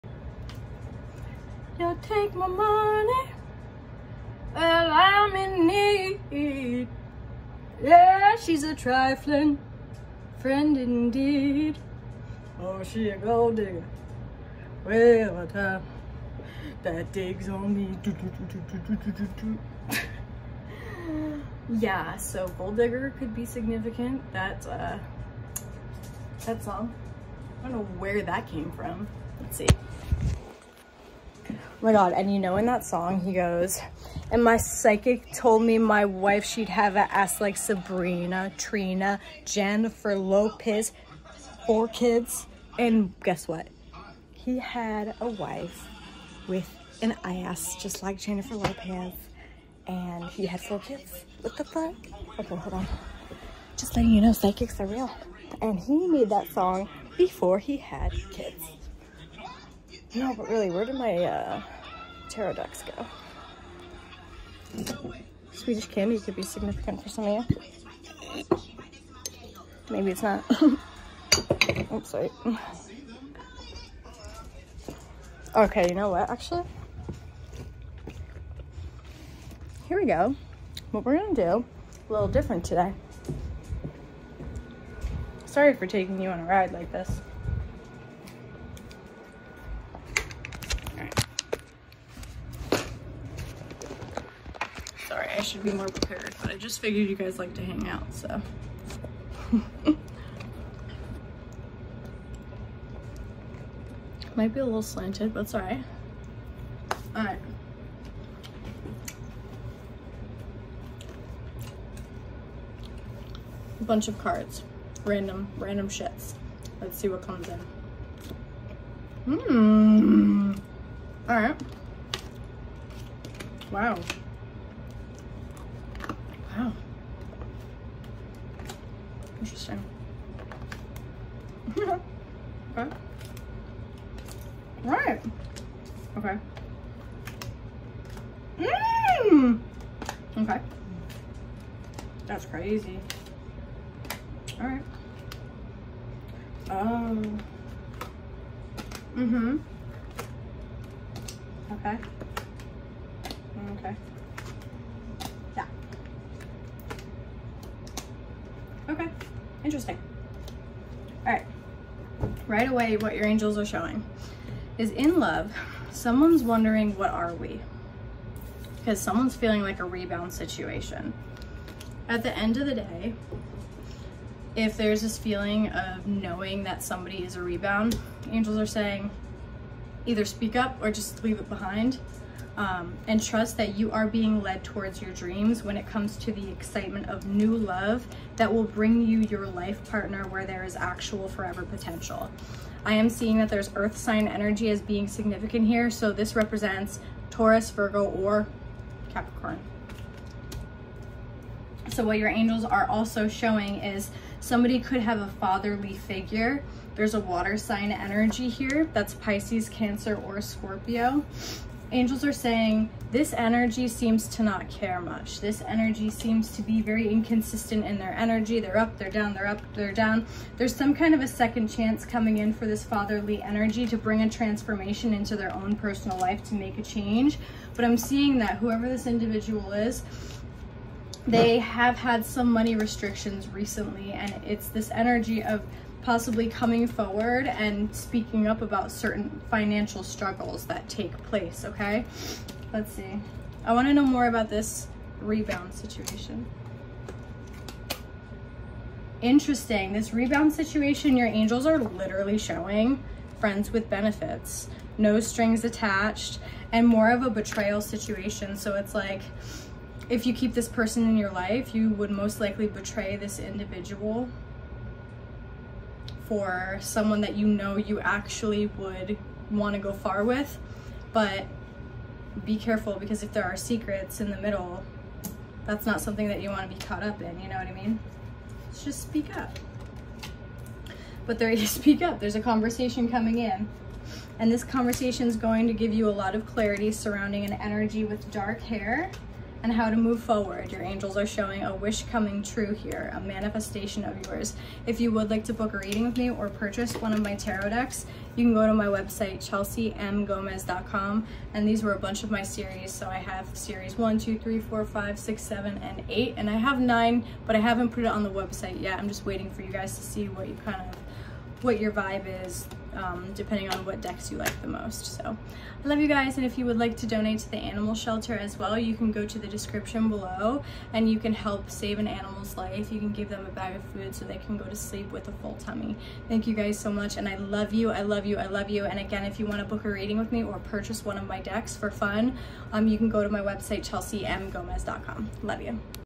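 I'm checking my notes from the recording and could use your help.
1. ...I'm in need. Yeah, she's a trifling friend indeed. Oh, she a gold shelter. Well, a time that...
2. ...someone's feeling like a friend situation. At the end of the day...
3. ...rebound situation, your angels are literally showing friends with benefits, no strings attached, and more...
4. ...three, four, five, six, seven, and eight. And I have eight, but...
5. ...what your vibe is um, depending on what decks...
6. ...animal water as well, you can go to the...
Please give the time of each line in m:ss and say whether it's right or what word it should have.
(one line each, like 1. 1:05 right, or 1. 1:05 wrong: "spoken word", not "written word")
1. 0:04 wrong: "digger", not "shelter"
2. 2:48 wrong: "rebound", not "friend"
3. 4:10 right
4. 5:04 wrong: "nine", not "eight"
5. 5:11 right
6. 5:17 wrong: "shelter", not "water".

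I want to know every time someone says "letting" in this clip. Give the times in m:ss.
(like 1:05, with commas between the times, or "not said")
0:53.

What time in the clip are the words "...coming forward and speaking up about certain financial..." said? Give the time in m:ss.
3:56.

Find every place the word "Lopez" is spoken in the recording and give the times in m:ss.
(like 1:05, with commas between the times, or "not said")
0:40, 0:48.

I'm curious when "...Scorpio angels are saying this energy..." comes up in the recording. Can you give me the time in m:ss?
3:30.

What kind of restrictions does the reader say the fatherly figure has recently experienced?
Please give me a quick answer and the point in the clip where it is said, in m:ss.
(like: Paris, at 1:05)
Money restrictions, at 3:52.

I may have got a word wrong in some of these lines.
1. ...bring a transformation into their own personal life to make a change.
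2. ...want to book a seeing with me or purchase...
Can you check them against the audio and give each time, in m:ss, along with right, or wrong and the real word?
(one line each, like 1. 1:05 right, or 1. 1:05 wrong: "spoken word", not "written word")
1. 3:43 right
2. 5:29 wrong: "reading", not "seeing".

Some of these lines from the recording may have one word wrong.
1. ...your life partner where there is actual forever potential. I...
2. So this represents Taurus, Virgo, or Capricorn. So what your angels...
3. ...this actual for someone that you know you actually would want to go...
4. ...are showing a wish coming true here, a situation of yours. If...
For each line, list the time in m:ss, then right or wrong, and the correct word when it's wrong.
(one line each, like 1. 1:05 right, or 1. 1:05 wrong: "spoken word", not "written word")
1. 3:09 right
2. 3:15 right
3. 4:23 wrong: "individual", not "actual"
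4. 4:51 wrong: "manifestation", not "situation".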